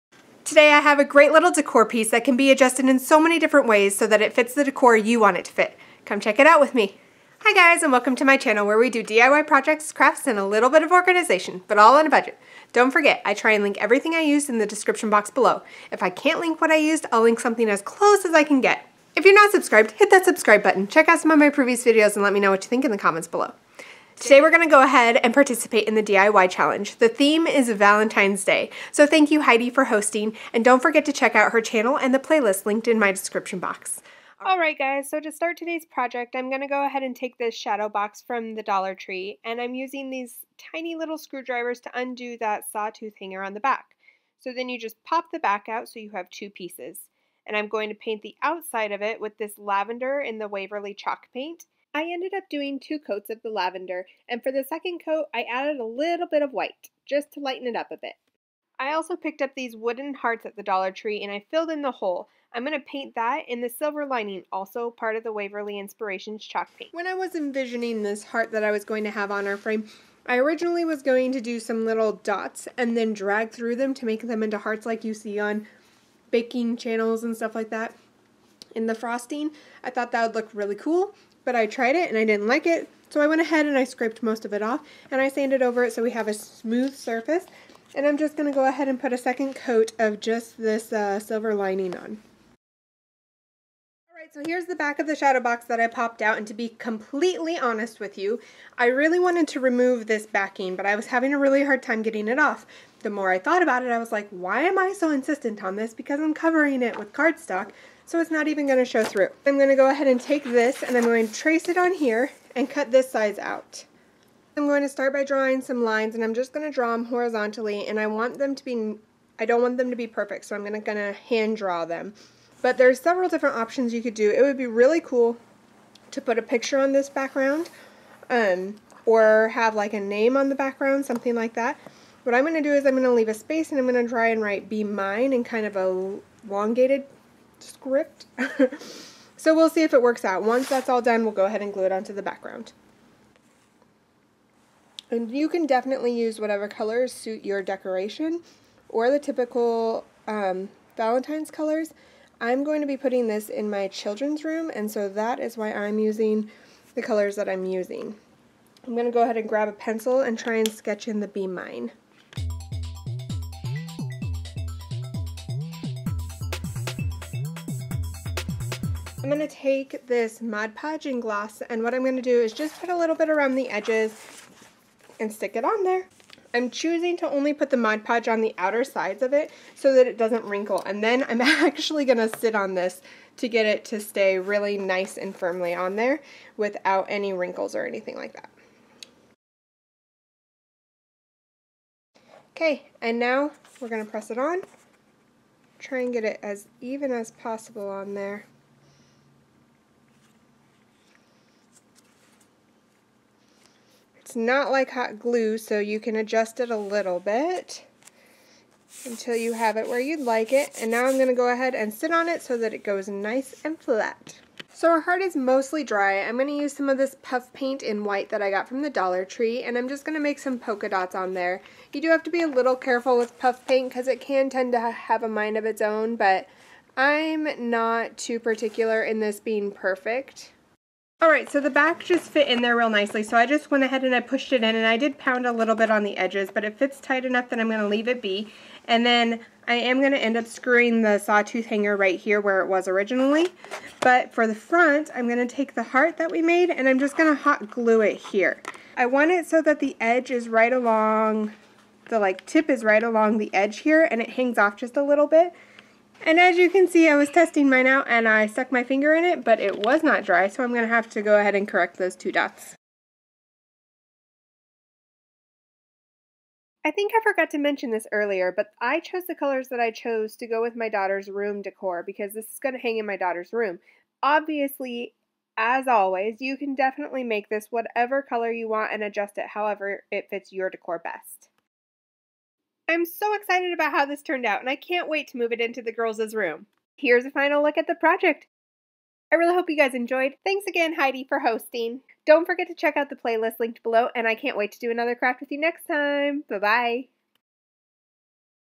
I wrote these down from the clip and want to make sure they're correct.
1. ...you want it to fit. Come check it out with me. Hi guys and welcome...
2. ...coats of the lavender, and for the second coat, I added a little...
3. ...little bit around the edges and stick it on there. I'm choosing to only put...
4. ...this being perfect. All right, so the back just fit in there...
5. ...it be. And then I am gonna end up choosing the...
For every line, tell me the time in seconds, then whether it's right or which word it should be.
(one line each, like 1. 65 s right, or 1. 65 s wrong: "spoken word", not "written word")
1. 4 s right
2. 52 s right
3. 172 s right
4. 229 s right
5. 238 s wrong: "screwing", not "choosing".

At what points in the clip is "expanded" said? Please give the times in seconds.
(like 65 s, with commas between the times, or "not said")
not said.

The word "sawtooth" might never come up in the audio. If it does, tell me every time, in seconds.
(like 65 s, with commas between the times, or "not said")
42 s, 241 s.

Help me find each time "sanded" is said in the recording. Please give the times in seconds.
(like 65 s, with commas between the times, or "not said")
85 s.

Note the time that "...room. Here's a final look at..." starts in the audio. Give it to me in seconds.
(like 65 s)
286 s.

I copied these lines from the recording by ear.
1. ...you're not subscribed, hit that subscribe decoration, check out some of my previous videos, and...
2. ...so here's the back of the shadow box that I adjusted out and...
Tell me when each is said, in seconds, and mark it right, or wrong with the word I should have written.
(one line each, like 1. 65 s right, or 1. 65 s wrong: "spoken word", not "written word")
1. 19 s wrong: "button", not "decoration"
2. 94 s wrong: "popped", not "adjusted".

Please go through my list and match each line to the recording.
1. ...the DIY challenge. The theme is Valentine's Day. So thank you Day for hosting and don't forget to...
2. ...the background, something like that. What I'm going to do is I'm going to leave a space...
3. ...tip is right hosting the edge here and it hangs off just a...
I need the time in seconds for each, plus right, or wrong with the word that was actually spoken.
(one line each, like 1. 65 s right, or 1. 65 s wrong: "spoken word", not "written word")
1. 25 s wrong: "Heidi", not "Day"
2. 130 s right
3. 252 s wrong: "along", not "hosting".